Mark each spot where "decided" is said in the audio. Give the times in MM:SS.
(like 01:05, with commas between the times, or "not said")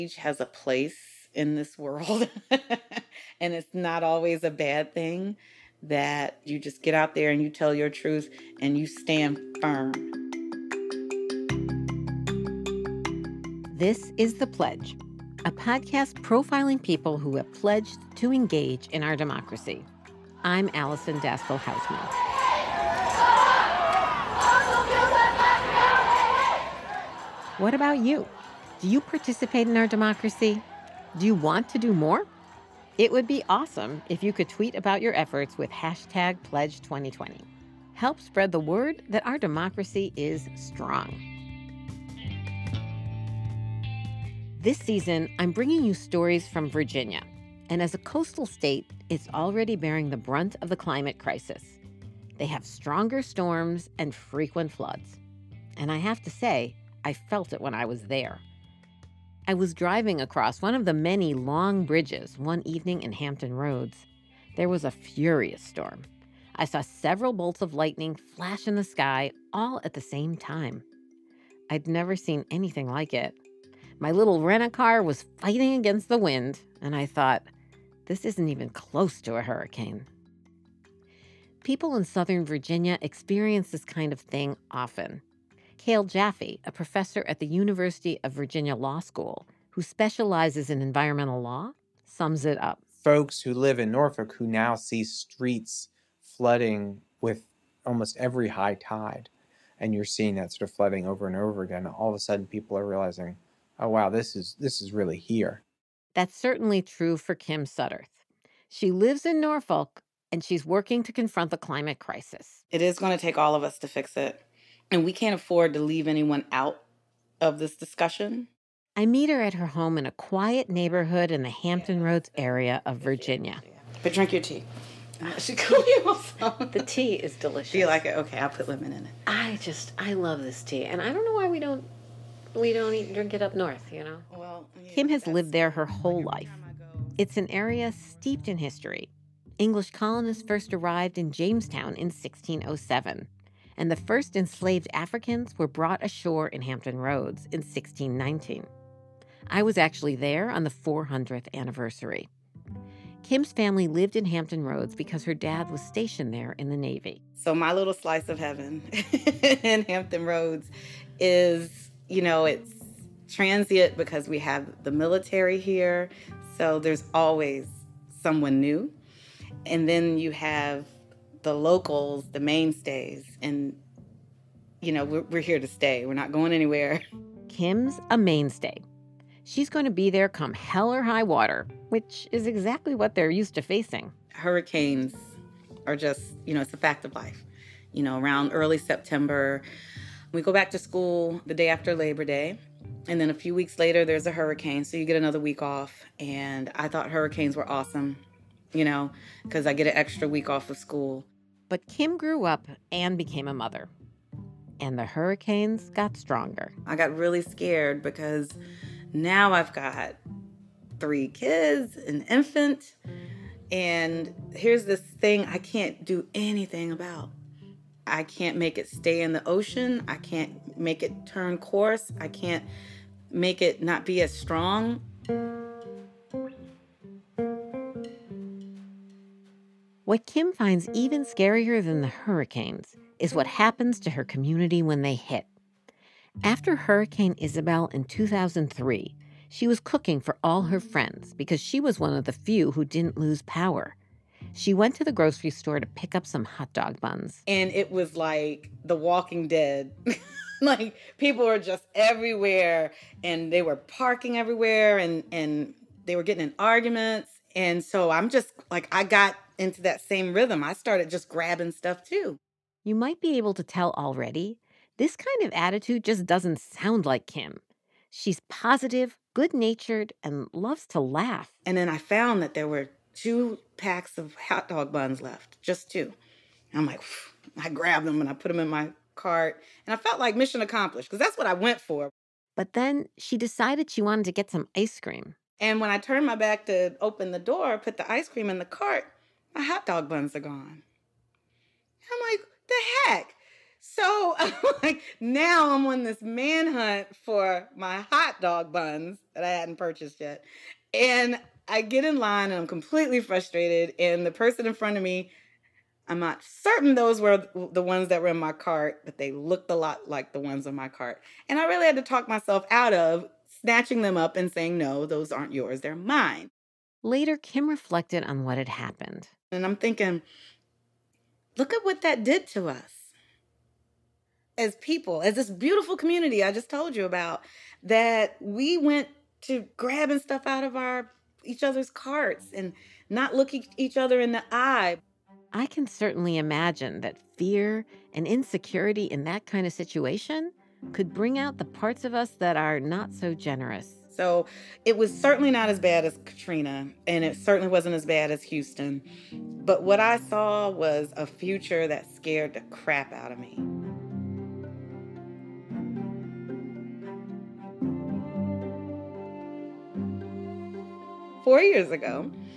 04:43.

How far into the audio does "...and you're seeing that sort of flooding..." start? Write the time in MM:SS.
01:39.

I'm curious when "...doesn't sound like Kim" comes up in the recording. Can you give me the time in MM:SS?
04:26.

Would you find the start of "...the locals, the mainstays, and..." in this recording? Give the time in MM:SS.
02:51.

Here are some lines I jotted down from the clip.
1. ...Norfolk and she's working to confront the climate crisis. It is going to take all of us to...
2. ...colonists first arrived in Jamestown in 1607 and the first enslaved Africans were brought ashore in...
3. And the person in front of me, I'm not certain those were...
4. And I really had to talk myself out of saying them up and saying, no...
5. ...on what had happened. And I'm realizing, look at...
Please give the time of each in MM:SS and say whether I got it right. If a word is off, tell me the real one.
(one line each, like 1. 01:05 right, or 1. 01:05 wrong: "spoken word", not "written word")
1. 01:49 right
2. 02:19 right
3. 05:03 right
4. 05:11 wrong: "snatching", not "saying"
5. 05:18 wrong: "thinking", not "realizing".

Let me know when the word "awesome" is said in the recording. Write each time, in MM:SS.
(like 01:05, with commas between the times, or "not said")
00:33, 03:17.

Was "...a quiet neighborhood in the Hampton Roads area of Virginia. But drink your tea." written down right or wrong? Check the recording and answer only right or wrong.
right.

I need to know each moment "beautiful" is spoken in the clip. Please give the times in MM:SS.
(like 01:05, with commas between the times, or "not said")
05:25.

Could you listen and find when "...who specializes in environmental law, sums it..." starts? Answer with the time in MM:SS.
01:29.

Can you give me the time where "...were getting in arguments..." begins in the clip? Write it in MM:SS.
04:16.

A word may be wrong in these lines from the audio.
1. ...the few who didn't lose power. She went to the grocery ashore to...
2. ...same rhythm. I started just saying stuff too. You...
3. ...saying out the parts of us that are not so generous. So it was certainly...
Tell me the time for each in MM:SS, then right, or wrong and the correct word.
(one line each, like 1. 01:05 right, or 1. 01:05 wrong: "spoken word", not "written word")
1. 04:02 wrong: "store", not "ashore"
2. 04:19 wrong: "grabbing", not "saying"
3. 05:41 wrong: "bring", not "saying".